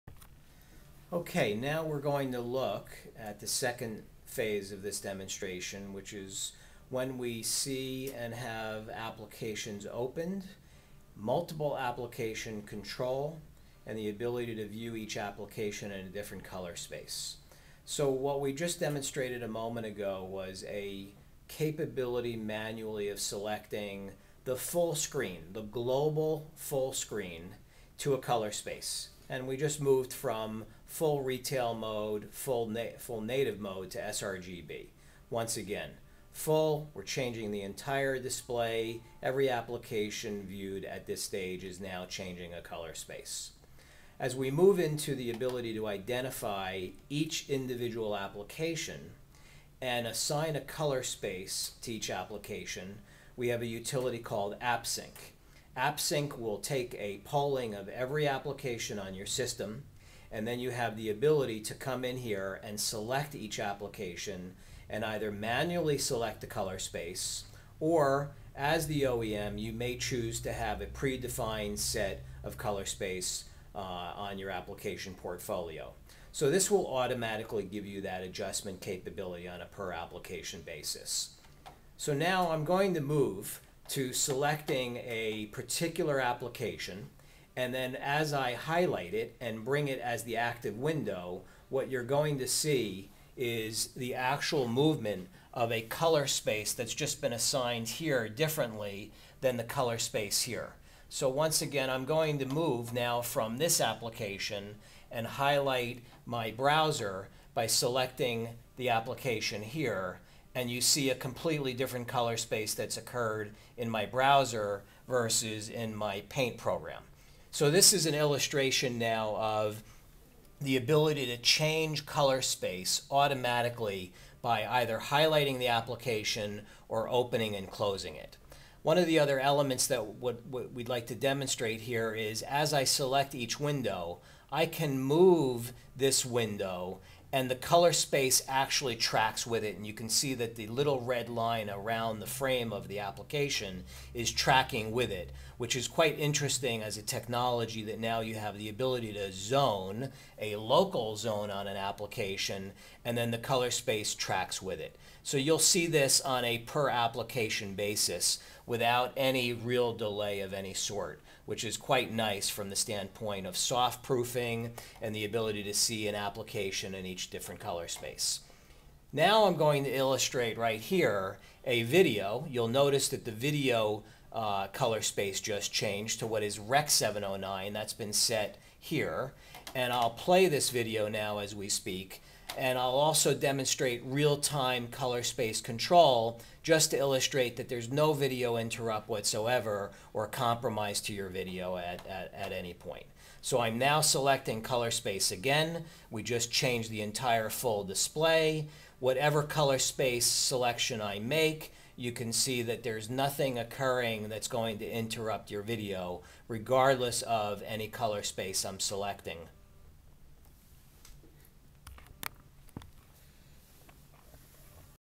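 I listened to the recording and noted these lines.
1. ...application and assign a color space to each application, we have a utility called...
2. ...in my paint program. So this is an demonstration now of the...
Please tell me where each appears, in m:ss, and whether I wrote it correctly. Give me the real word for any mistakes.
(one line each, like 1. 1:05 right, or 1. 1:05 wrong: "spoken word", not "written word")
1. 0:48 right
2. 1:55 wrong: "illustration", not "demonstration".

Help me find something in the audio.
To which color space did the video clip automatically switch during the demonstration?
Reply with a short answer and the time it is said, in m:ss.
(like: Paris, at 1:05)
Rec 709, at 2:56.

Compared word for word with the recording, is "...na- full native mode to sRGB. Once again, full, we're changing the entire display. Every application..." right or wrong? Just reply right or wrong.
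right.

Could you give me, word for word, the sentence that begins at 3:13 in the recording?
So I'm now selecting color space again.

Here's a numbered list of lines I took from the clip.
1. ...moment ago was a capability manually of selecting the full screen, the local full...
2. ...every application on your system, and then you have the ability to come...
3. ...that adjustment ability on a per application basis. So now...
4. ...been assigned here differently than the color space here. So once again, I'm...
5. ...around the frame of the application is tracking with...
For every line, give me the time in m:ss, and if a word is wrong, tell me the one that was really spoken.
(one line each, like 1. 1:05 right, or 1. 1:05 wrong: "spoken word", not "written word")
1. 0:19 wrong: "global", not "local"
2. 0:57 right
3. 1:18 wrong: "capability", not "ability"
4. 1:37 right
5. 2:21 right.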